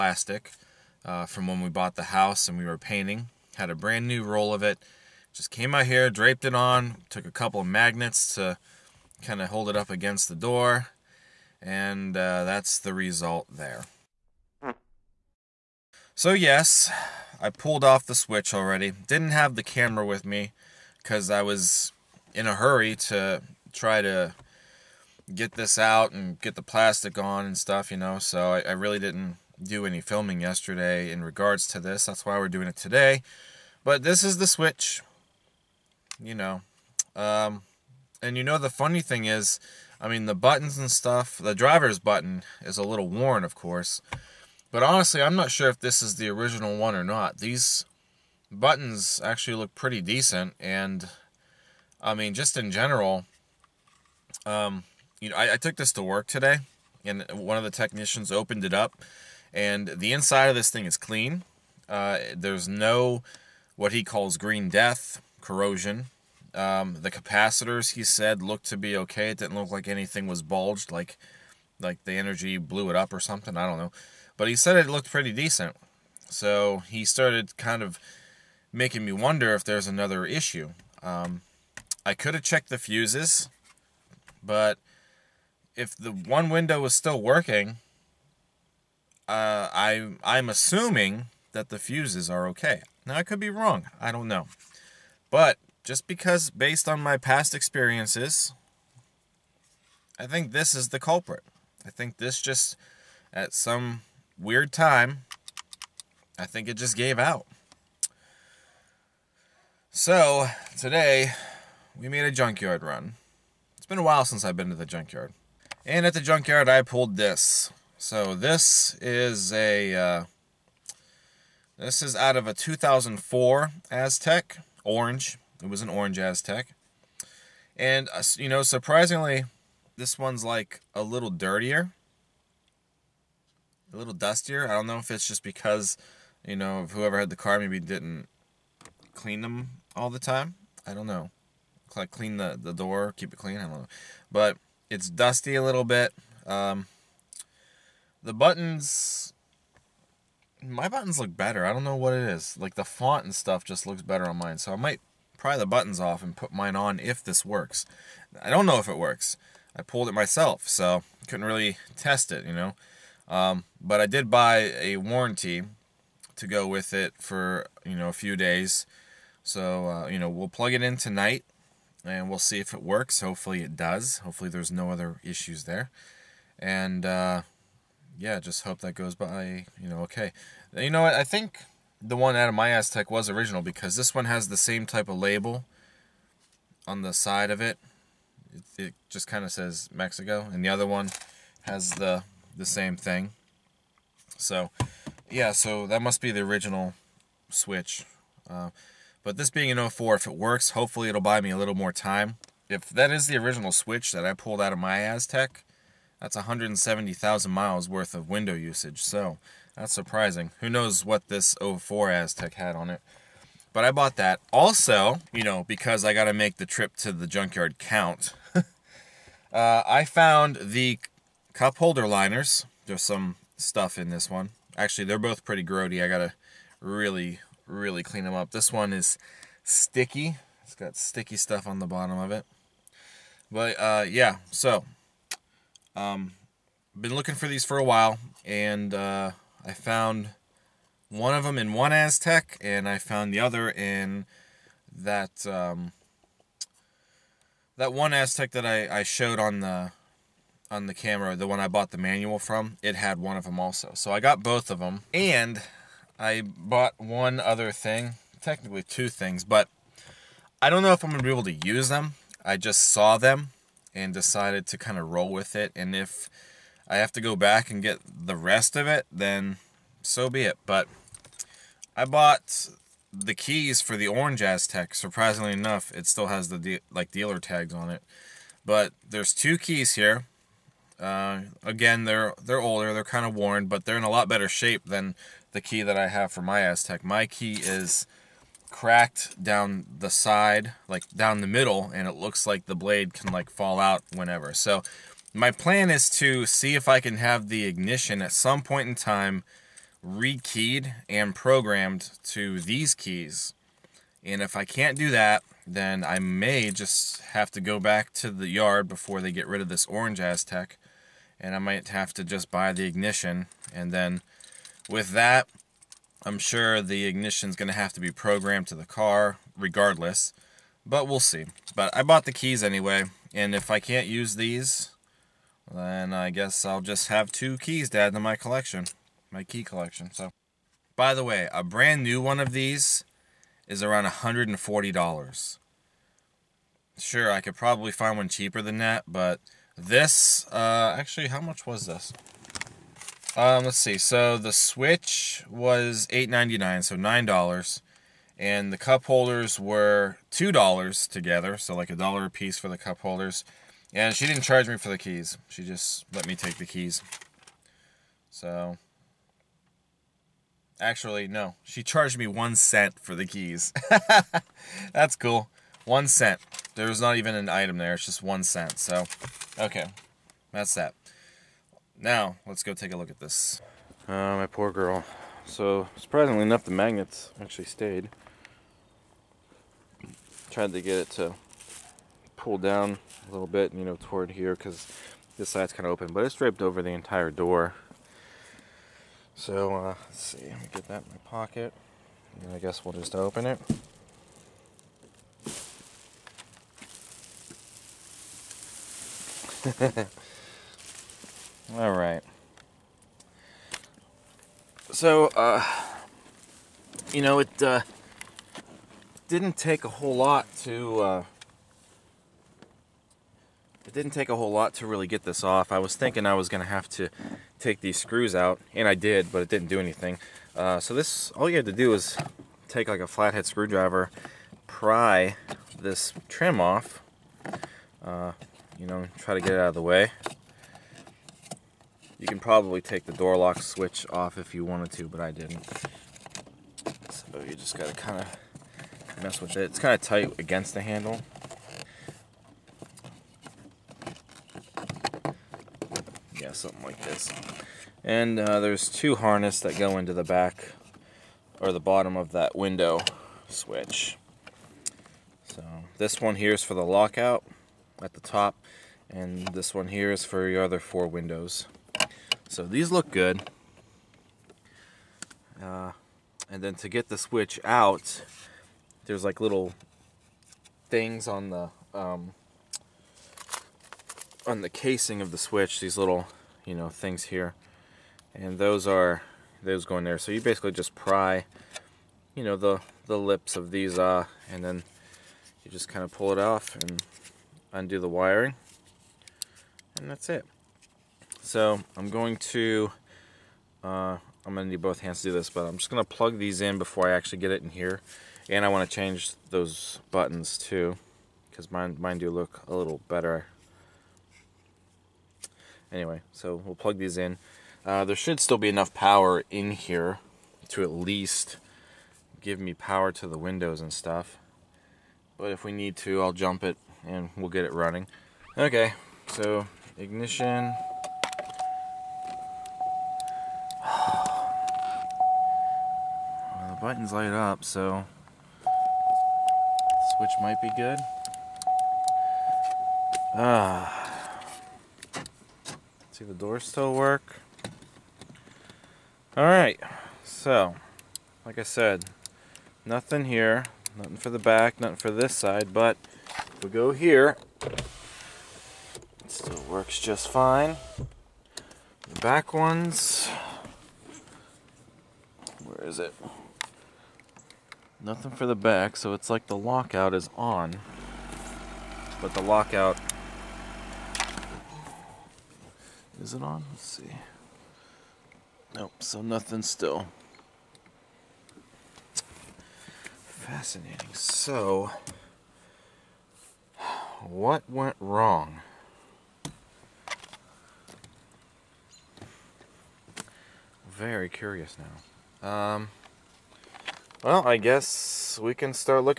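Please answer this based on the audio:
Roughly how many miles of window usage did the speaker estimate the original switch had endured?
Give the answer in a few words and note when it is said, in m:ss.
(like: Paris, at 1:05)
170,000, at 3:26.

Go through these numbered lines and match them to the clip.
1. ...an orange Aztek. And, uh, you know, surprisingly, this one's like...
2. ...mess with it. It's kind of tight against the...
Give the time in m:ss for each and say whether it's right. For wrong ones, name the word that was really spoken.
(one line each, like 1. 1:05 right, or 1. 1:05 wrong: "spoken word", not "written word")
1. 2:05 right
2. 7:19 right.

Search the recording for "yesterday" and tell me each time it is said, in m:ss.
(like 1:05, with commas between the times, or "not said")
0:30.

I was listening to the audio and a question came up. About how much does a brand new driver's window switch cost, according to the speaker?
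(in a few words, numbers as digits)
$140.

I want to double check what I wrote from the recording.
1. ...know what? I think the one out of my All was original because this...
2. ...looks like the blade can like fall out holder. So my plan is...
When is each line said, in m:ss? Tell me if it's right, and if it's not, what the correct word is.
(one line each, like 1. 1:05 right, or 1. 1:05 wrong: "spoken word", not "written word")
1. 3:00 wrong: "Aztek", not "All"
2. 4:52 wrong: "whenever", not "holder".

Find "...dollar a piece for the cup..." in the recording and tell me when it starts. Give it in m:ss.
5:51.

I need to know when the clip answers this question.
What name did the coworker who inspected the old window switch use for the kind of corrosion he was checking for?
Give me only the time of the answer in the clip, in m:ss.
1:04.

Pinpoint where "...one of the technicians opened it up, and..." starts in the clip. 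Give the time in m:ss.
0:57.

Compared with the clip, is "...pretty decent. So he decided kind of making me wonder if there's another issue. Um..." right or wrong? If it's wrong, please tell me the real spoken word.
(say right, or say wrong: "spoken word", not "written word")
wrong: "started", not "decided".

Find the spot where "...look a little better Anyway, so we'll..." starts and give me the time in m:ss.
8:22.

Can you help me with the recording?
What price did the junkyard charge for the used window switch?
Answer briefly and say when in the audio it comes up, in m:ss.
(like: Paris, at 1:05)
$8.99, at 5:46.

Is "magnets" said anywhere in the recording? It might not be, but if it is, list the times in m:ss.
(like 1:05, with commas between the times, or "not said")
0:07, 6:16.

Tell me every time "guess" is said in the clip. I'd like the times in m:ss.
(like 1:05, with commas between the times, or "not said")
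5:26, 6:32, 9:47.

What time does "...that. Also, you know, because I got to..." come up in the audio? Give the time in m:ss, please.
3:34.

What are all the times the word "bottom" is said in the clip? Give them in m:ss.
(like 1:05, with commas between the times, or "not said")
3:51, 7:31.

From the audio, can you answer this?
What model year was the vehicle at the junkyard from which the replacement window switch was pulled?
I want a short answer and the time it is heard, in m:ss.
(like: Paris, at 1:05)
2004, at 2:02.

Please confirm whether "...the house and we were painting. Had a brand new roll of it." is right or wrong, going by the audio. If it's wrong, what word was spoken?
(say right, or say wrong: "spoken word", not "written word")
right.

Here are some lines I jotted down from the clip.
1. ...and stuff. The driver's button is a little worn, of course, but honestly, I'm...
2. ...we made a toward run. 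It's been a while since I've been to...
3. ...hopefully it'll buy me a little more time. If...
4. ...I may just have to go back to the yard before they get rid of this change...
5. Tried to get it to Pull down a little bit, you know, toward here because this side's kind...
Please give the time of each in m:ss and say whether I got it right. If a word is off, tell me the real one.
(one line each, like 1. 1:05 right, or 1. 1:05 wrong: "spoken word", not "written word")
1. 0:40 right
2. 1:51 wrong: "junkyard", not "toward"
3. 3:20 right
4. 5:06 wrong: "orange", not "change"
5. 6:20 right.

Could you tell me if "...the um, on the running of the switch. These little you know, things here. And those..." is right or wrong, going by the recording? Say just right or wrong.
wrong.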